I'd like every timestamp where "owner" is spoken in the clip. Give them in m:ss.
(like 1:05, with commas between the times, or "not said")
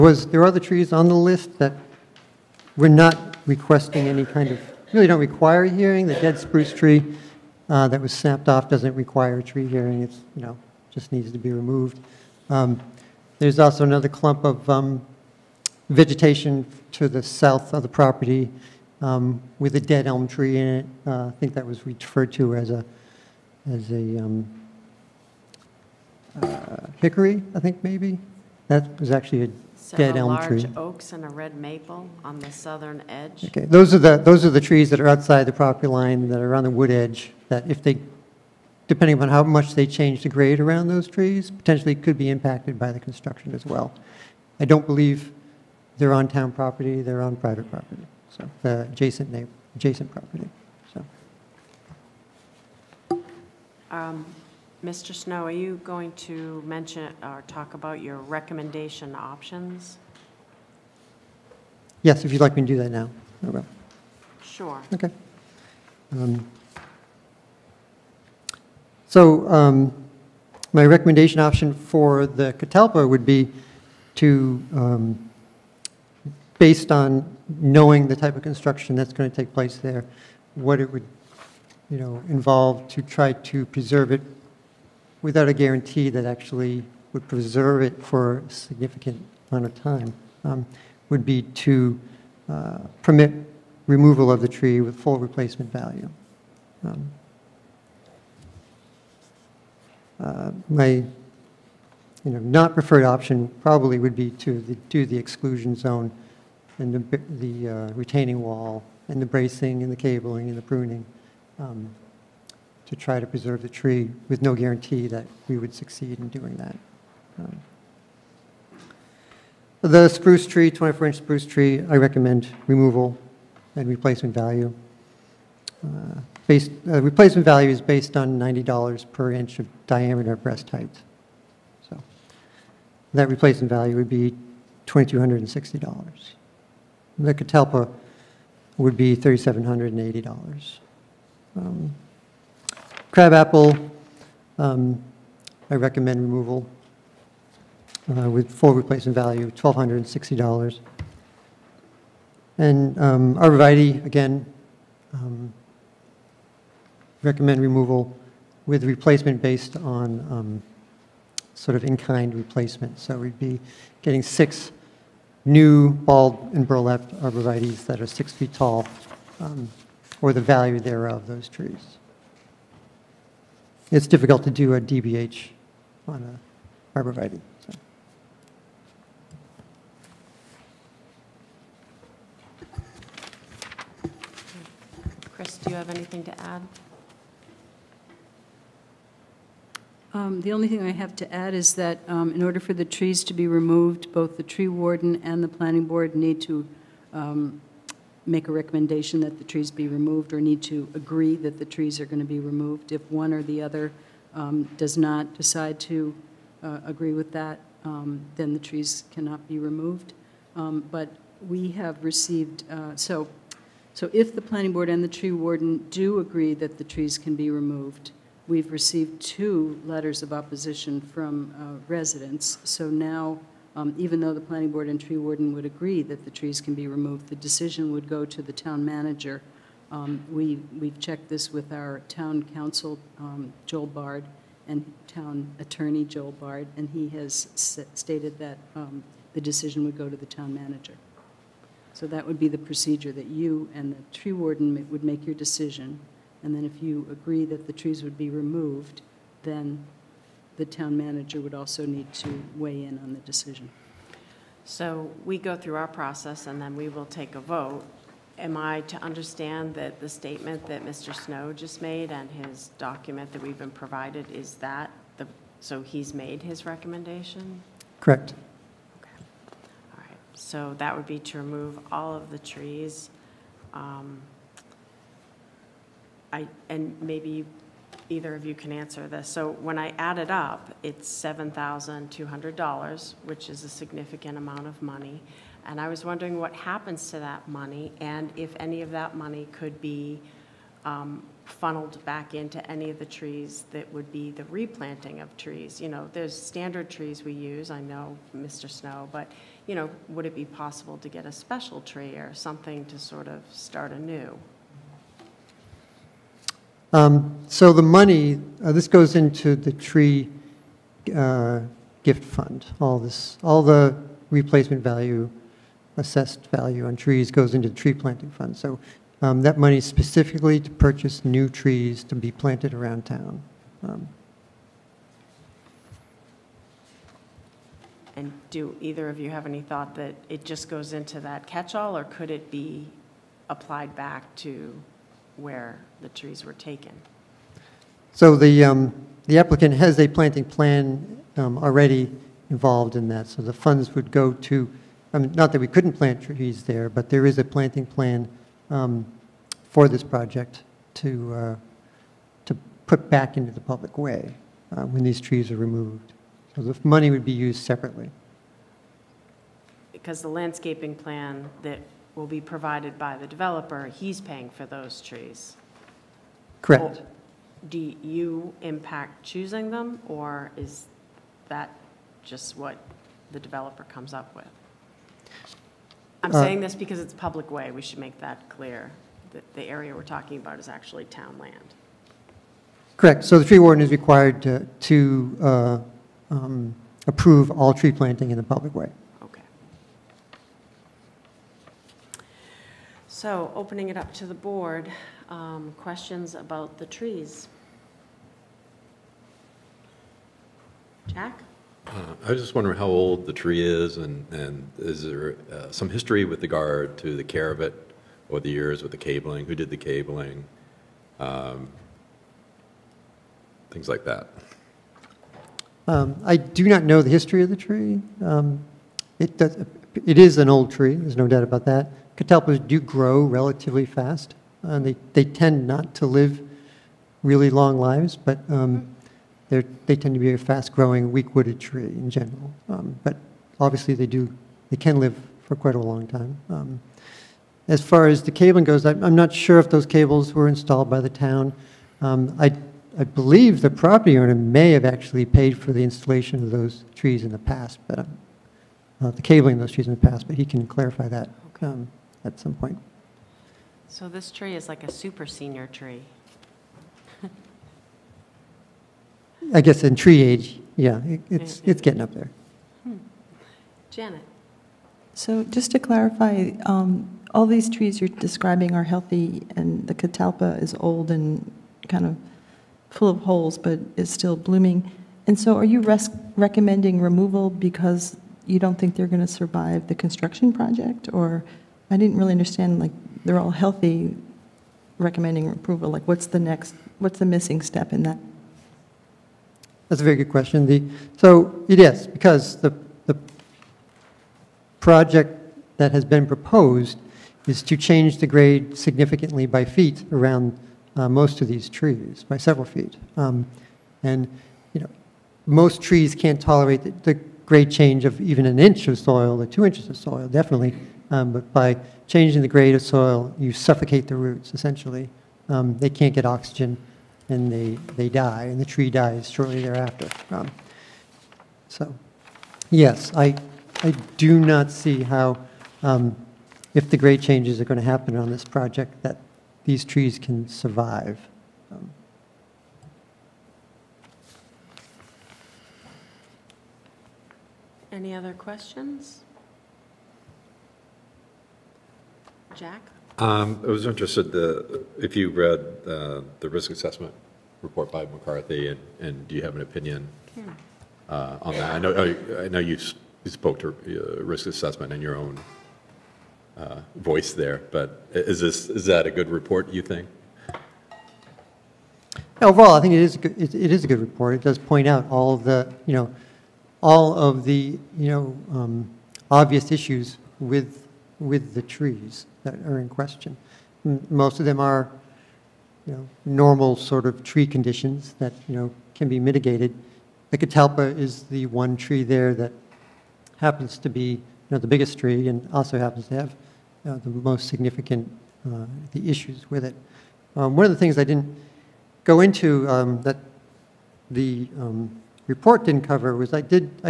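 7:24.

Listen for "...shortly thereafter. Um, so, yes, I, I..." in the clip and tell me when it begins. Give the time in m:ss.
8:39.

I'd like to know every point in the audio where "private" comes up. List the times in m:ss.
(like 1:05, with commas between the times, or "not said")
0:47.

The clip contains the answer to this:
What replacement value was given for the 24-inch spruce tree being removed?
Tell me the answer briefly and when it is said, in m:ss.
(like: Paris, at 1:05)
$2,260, at 2:14.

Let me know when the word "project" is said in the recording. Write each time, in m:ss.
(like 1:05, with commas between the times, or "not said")
5:50, 8:00, 8:14, 8:48.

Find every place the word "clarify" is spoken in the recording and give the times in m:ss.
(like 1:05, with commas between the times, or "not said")
7:30, 7:45.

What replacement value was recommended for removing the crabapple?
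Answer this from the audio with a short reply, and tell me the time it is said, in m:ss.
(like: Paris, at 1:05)
$1,260, at 2:29.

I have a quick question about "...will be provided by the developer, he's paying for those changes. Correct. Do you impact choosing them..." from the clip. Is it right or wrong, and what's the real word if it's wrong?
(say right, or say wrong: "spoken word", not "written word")
wrong: "trees", not "changes".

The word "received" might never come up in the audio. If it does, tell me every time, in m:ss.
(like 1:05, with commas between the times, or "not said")
3:32, 3:38.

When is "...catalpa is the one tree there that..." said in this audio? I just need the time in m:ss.
9:40.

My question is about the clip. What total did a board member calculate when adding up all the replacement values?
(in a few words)
$7,200.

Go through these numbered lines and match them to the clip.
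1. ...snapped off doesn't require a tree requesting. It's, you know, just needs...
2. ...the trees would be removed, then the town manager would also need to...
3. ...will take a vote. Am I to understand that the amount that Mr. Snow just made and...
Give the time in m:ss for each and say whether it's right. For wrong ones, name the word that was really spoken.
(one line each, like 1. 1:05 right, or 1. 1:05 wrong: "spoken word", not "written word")
1. 0:08 wrong: "hearing", not "requesting"
2. 4:07 right
3. 4:16 wrong: "statement", not "amount".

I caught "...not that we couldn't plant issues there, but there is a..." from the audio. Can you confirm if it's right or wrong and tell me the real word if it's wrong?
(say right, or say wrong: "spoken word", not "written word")
wrong: "trees", not "issues".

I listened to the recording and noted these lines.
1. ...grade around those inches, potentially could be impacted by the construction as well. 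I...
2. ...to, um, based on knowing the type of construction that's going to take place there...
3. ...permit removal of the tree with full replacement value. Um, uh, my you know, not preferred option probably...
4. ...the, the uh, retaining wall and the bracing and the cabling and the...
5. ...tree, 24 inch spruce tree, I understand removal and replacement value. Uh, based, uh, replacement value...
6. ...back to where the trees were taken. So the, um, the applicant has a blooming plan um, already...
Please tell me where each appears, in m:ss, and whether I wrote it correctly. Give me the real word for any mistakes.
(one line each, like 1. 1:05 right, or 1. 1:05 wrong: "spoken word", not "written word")
1. 0:40 wrong: "trees", not "inches"
2. 1:14 right
3. 1:33 right
4. 1:46 right
5. 2:00 wrong: "recommend", not "understand"
6. 5:33 wrong: "planting", not "blooming".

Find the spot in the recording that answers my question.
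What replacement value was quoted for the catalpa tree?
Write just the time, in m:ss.
2:19.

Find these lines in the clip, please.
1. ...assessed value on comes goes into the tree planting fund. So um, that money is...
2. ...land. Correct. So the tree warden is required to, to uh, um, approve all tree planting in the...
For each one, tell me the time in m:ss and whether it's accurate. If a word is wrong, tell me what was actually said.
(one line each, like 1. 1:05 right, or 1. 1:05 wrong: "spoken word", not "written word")
1. 5:15 wrong: "trees", not "comes"
2. 6:21 right.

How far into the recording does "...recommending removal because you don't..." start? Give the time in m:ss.
7:56.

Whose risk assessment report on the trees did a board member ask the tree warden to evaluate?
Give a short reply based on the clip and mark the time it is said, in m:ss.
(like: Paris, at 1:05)
McCarthy, at 9:08.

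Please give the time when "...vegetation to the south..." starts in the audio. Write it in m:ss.
0:15.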